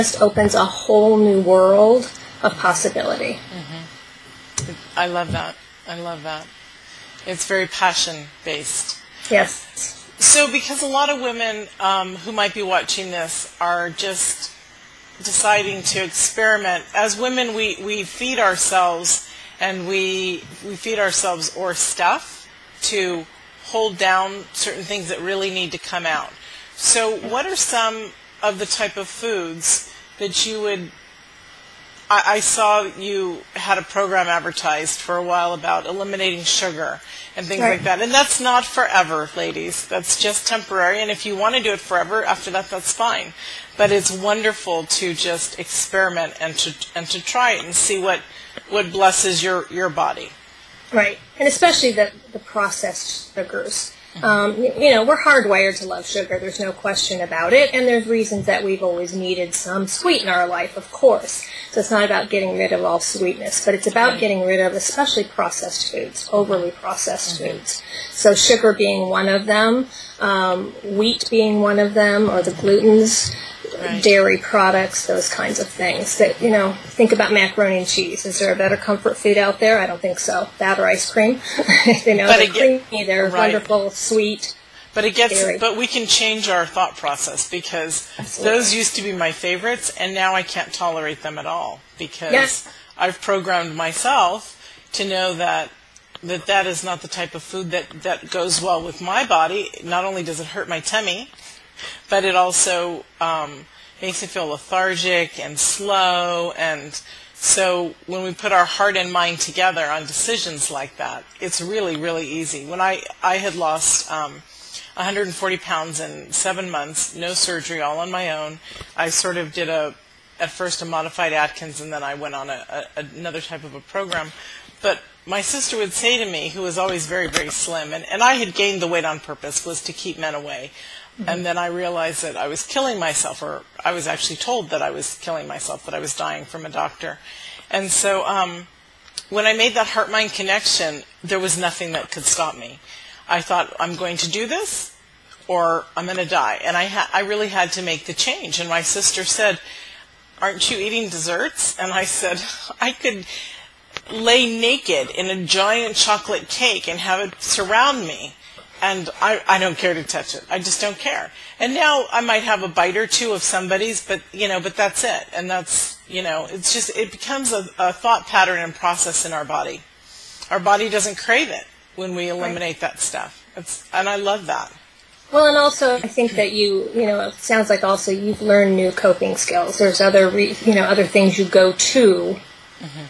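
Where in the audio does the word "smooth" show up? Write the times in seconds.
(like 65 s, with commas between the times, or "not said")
not said.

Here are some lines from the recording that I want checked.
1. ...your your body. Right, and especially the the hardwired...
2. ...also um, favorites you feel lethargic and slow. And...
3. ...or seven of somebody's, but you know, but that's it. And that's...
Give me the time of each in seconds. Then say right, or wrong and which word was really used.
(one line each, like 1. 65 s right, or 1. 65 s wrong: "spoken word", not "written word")
1. 49 s wrong: "processed", not "hardwired"
2. 102 s wrong: "makes", not "favorites"
3. 162 s wrong: "two", not "seven".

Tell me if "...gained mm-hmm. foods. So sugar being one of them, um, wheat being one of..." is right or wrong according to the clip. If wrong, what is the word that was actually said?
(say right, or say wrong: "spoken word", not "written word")
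wrong: "processed", not "gained".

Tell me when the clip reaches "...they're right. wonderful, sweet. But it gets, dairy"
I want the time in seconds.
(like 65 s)
83 s.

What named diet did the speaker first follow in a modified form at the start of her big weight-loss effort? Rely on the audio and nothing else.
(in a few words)
Atkins.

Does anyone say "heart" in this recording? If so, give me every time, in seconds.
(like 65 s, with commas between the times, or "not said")
108 s, 139 s.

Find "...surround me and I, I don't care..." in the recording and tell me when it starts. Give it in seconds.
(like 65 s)
157 s.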